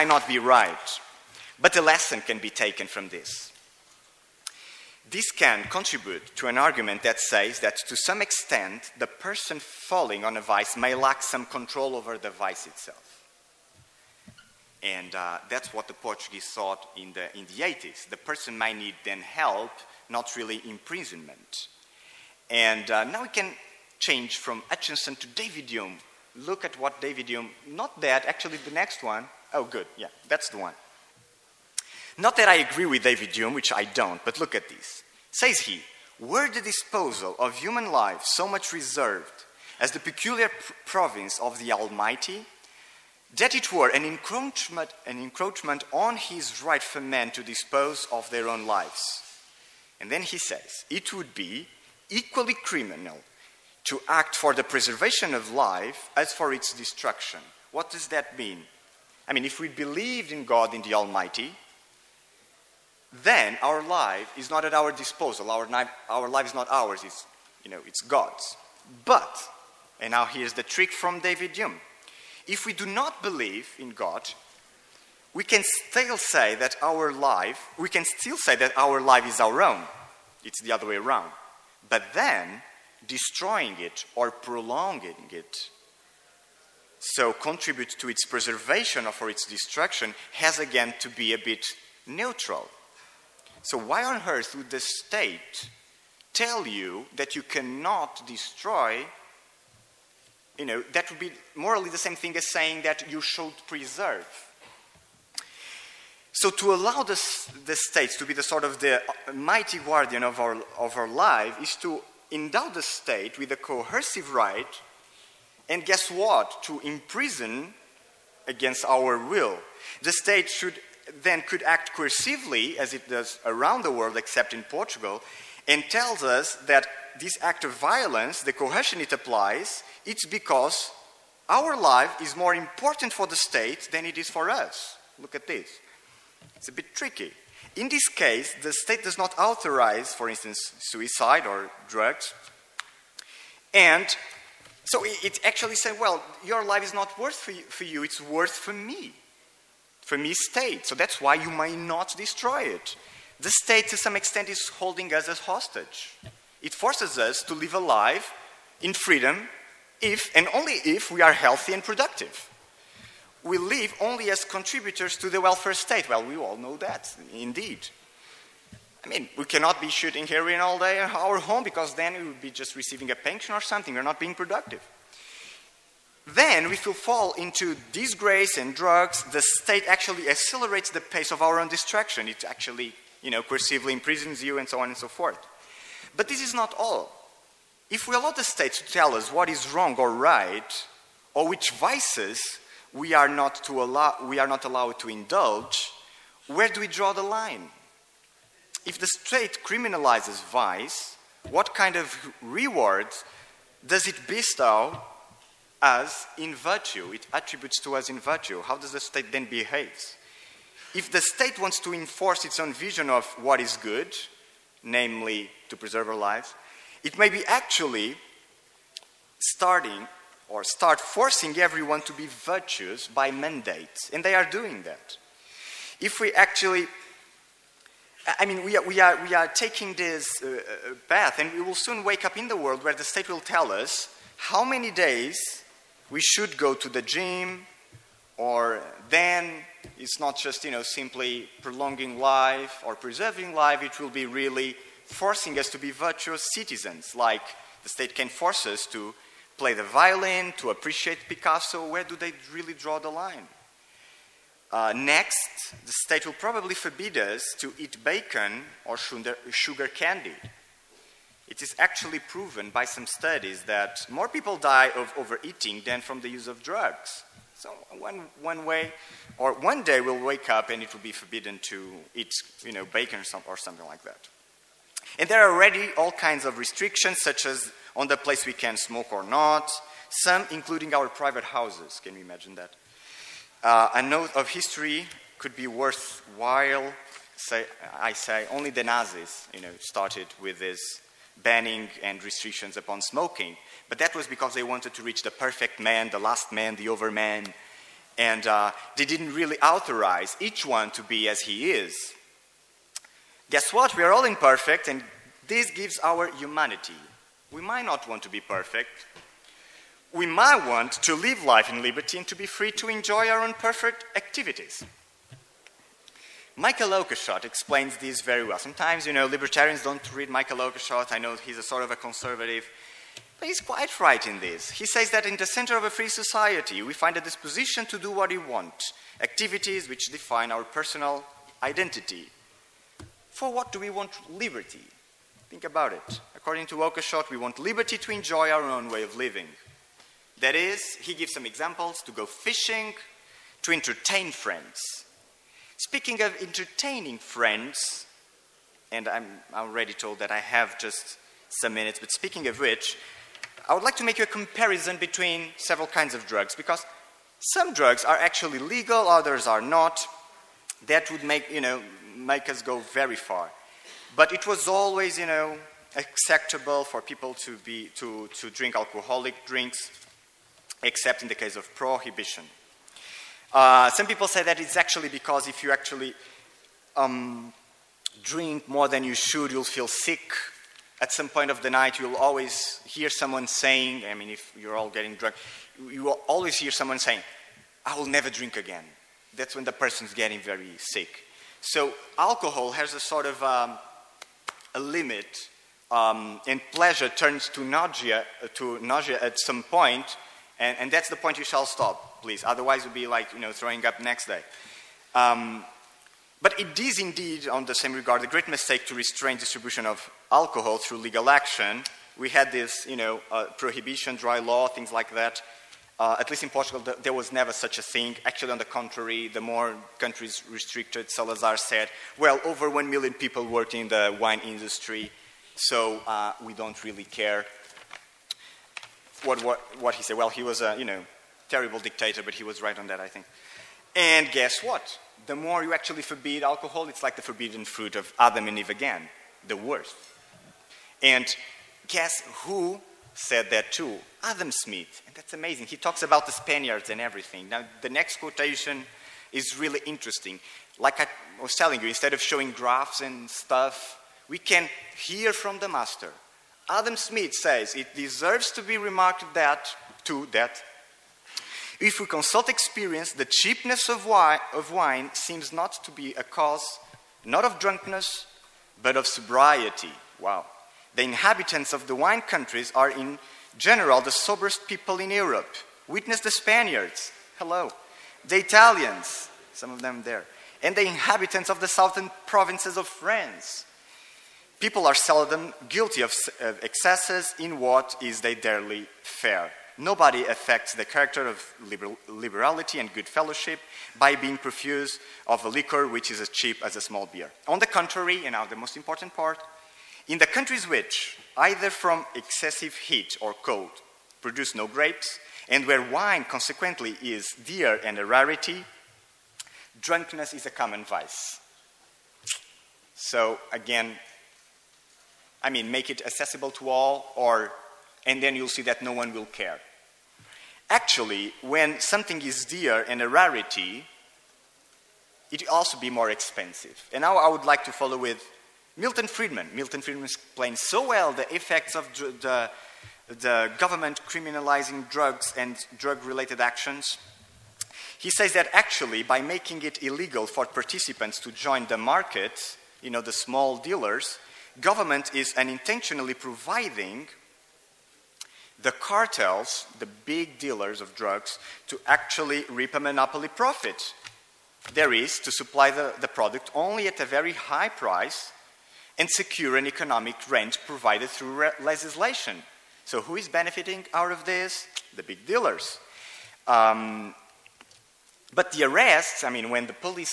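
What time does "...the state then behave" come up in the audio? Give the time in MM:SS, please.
03:28.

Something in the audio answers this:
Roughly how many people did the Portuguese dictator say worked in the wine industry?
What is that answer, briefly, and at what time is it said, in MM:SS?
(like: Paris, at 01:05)
Over 1 million, at 07:02.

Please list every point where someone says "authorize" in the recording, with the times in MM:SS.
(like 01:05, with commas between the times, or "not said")
02:19, 04:59.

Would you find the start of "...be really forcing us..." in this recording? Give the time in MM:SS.
04:04.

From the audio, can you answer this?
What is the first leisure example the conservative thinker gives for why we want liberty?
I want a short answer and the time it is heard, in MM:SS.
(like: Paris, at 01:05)
To go fishing, at 05:42.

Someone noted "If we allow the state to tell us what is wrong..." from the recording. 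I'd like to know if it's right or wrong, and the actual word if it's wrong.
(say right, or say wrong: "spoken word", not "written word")
right.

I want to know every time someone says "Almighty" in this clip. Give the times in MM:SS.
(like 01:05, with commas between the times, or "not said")
00:41, 01:00.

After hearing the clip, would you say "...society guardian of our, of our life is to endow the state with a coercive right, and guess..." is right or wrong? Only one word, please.
wrong.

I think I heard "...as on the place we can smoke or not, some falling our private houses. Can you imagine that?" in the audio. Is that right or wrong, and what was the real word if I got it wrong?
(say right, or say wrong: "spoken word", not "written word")
wrong: "including", not "falling".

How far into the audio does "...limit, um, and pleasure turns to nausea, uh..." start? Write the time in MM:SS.
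06:34.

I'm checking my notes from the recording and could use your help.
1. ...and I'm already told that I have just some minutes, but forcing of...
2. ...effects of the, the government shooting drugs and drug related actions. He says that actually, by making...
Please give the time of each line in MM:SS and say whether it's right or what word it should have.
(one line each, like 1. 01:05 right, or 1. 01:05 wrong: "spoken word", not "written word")
1. 05:48 wrong: "speaking", not "forcing"
2. 08:51 wrong: "criminalizing", not "shooting".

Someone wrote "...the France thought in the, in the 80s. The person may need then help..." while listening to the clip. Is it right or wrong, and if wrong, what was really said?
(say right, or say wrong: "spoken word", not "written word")
wrong: "Portuguese", not "France".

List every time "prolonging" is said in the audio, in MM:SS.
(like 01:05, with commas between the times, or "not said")
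01:24, 04:01.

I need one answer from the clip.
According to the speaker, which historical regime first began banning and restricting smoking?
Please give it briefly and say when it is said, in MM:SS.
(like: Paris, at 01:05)
The Nazis, at 04:48.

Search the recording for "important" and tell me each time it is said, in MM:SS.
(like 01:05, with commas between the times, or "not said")
02:12, 08:18.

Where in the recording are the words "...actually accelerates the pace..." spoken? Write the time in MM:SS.
02:59.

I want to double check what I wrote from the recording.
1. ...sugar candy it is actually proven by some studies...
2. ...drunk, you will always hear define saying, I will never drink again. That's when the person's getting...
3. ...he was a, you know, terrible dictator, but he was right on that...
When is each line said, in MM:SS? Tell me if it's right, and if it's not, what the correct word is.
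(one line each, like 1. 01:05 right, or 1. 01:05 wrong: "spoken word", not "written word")
1. 04:19 right
2. 06:25 wrong: "someone", not "define"
3. 07:10 right.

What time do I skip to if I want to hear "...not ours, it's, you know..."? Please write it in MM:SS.
01:06.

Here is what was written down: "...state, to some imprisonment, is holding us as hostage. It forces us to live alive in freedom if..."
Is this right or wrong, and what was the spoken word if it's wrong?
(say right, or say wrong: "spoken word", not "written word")
wrong: "extent", not "imprisonment".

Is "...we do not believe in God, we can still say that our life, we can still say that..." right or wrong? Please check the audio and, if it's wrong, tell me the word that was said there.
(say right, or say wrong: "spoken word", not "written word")
right.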